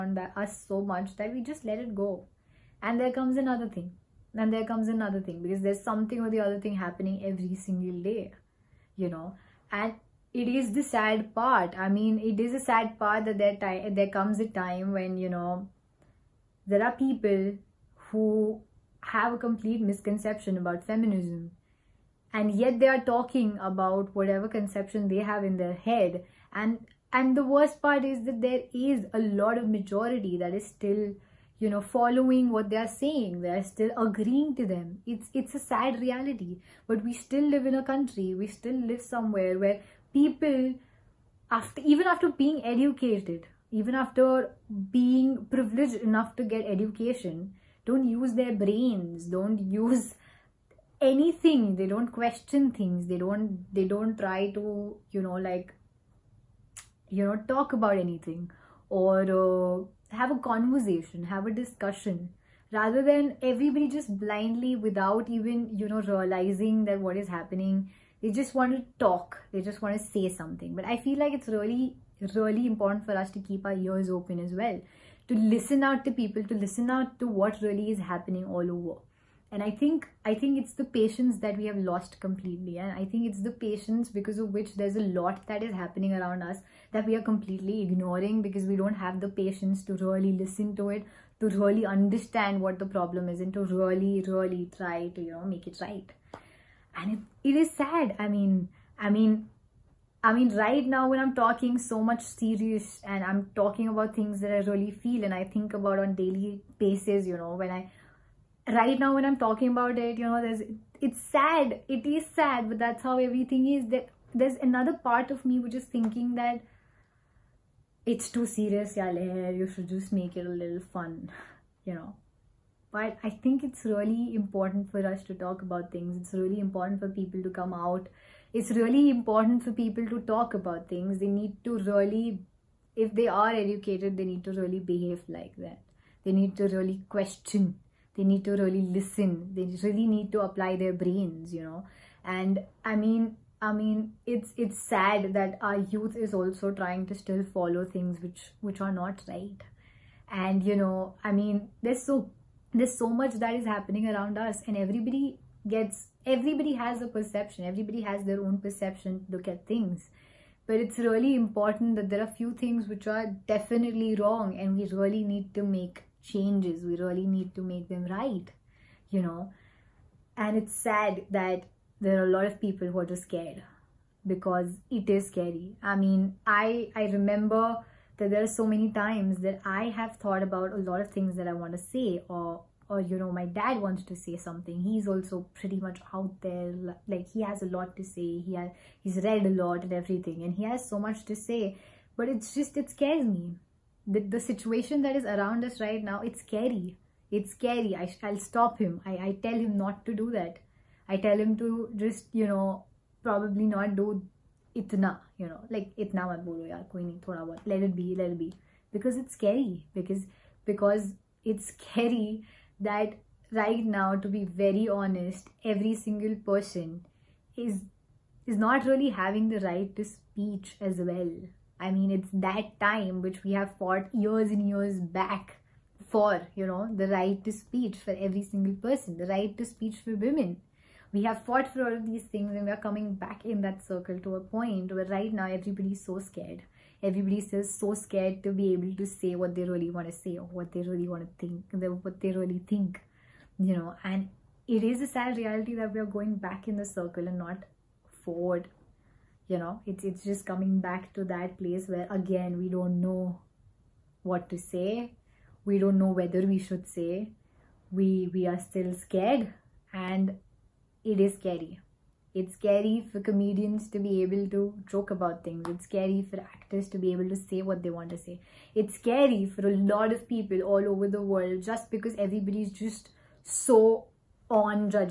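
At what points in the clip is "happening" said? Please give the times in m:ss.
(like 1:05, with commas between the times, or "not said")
0:06, 1:07, 1:18, 1:25, 2:33.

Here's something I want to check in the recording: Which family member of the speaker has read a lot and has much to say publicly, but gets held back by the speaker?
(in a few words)
dad.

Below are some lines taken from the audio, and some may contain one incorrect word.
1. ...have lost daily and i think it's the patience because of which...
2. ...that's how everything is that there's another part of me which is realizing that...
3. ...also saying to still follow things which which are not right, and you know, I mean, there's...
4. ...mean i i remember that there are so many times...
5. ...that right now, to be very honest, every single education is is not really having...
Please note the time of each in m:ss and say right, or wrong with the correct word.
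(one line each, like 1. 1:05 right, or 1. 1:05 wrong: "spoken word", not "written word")
1. 1:21 wrong: "completely", not "daily"
2. 1:52 wrong: "thinking", not "realizing"
3. 2:26 wrong: "trying", not "saying"
4. 2:55 right
5. 3:32 wrong: "person", not "education".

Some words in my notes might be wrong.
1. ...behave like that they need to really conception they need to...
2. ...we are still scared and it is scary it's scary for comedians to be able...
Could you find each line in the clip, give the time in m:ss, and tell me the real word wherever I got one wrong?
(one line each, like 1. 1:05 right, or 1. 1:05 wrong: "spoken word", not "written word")
1. 2:14 wrong: "question", not "conception"
2. 4:18 right.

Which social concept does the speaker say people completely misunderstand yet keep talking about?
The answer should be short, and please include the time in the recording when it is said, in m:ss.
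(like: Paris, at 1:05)
feminism, at 0:20.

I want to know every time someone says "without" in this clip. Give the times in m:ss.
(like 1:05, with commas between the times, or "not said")
1:04.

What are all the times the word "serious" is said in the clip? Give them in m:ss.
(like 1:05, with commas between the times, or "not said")
1:42, 1:58.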